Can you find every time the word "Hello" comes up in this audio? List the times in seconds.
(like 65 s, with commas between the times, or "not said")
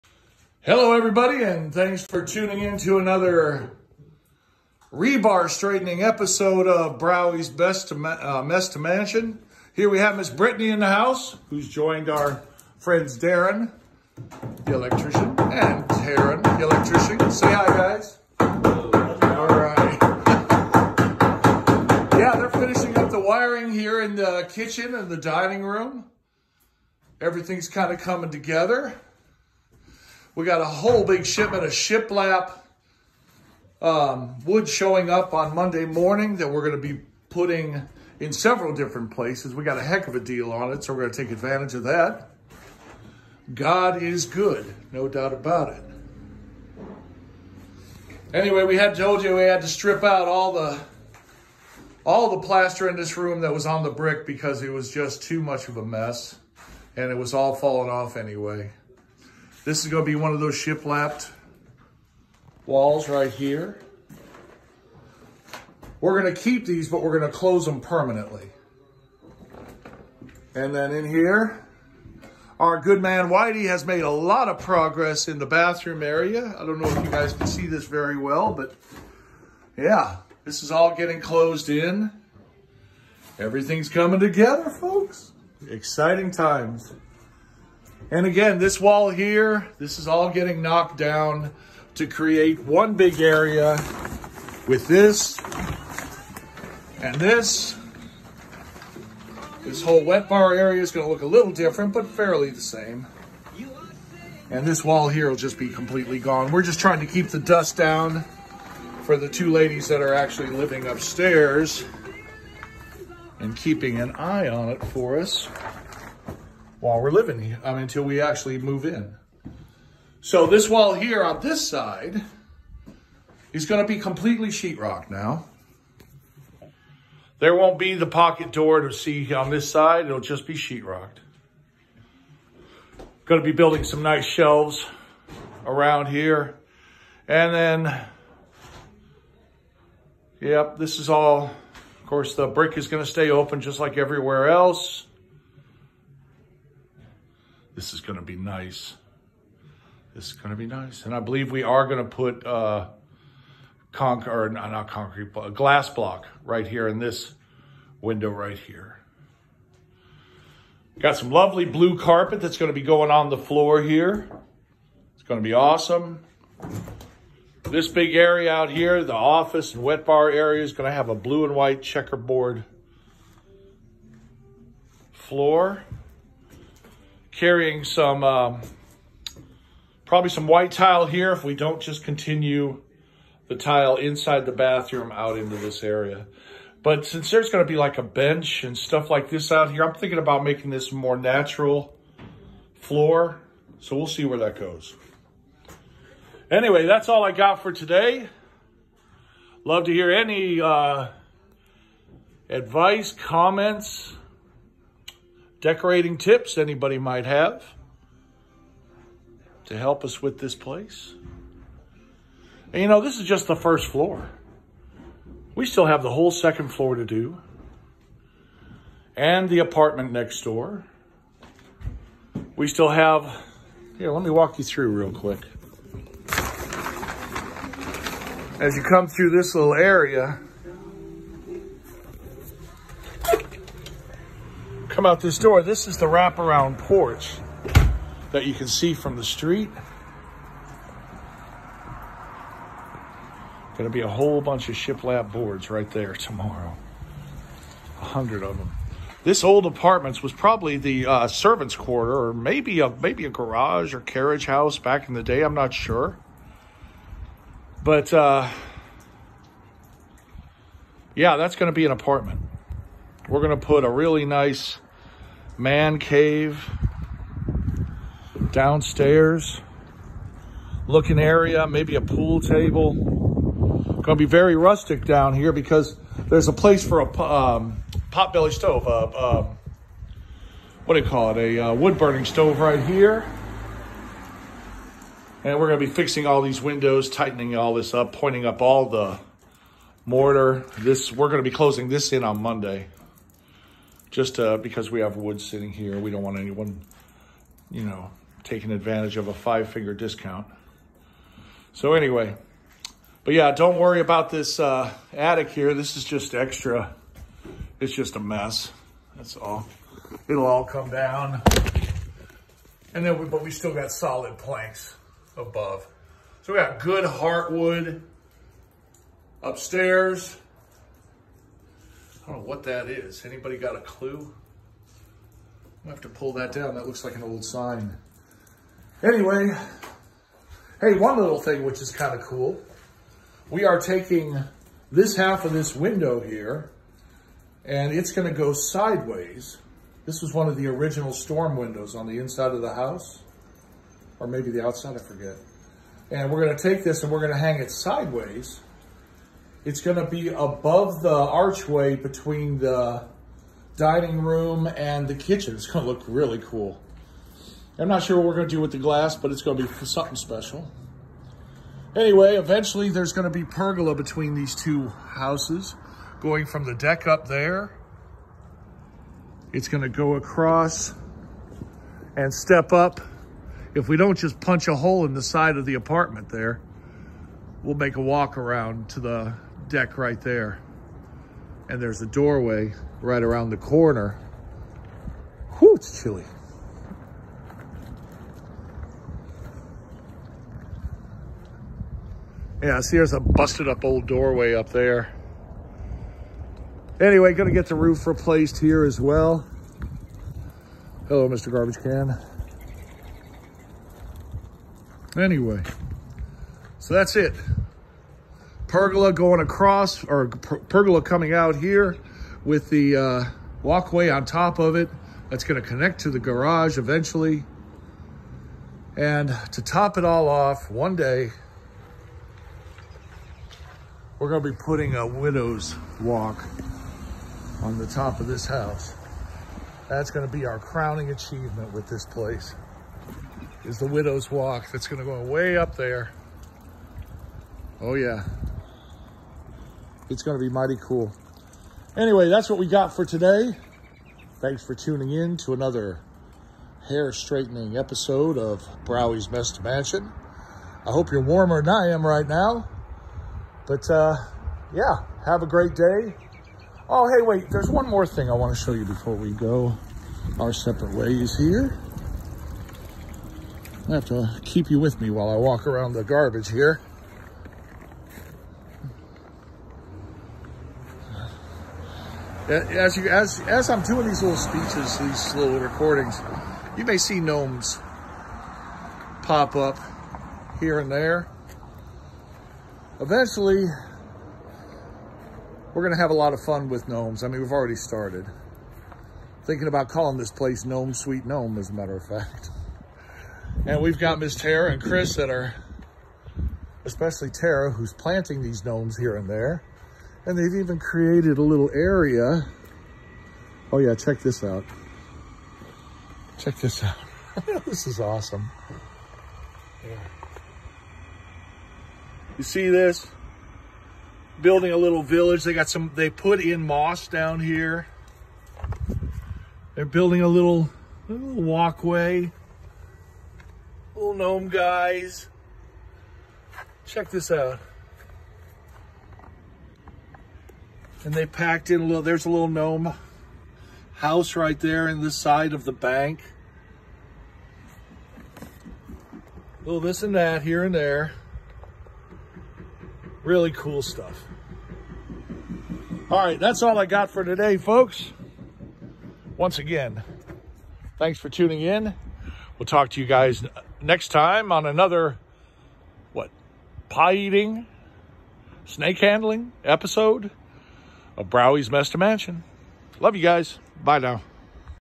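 0 s, 401 s.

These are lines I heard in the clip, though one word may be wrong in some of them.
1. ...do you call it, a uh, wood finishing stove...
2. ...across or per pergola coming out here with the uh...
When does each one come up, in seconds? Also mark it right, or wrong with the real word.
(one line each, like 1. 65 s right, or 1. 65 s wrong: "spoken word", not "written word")
1. 280 s wrong: "burning", not "finishing"
2. 409 s right.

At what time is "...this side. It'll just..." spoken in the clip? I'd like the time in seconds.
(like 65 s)
129 s.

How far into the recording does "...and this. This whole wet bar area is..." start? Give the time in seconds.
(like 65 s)
97 s.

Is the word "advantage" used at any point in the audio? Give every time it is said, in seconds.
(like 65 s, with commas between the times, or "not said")
41 s, 298 s.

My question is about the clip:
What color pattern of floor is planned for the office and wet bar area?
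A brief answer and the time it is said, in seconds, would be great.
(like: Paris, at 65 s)
Blue and white checkerboard, at 171 s.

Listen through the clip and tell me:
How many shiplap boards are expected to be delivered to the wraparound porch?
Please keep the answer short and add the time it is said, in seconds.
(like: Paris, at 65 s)
100, at 247 s.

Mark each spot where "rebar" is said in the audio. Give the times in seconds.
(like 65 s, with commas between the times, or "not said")
4 s.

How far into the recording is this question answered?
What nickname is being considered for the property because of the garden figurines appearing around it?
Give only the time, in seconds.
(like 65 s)
490 s.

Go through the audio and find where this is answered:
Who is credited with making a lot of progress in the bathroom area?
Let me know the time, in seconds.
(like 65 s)
73 s.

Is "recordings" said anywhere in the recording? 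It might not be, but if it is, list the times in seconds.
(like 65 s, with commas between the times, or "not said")
475 s.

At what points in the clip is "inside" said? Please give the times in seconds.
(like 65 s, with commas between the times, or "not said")
183 s, 342 s.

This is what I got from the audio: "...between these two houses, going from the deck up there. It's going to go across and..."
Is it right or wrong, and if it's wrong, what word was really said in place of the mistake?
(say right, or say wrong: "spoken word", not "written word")
right.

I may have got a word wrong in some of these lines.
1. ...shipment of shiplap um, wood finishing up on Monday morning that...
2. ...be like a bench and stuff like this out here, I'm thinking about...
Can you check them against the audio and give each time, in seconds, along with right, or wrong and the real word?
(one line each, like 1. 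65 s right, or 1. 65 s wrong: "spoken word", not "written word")
1. 31 s wrong: "showing", not "finishing"
2. 187 s right.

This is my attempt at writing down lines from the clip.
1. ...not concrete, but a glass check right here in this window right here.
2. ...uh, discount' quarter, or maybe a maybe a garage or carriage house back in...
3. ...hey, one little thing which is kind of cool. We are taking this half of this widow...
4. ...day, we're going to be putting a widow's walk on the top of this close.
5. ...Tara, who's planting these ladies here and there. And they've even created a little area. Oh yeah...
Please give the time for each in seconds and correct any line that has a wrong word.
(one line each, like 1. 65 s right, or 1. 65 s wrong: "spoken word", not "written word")
1. 154 s wrong: "block", not "check"
2. 251 s wrong: "servants", not "discount"
3. 330 s wrong: "window", not "widow"
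4. 420 s wrong: "house", not "close"
5. 497 s wrong: "gnomes", not "ladies".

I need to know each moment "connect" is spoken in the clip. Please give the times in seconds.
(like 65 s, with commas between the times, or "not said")
415 s.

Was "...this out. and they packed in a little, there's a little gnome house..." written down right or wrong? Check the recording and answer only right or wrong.
right.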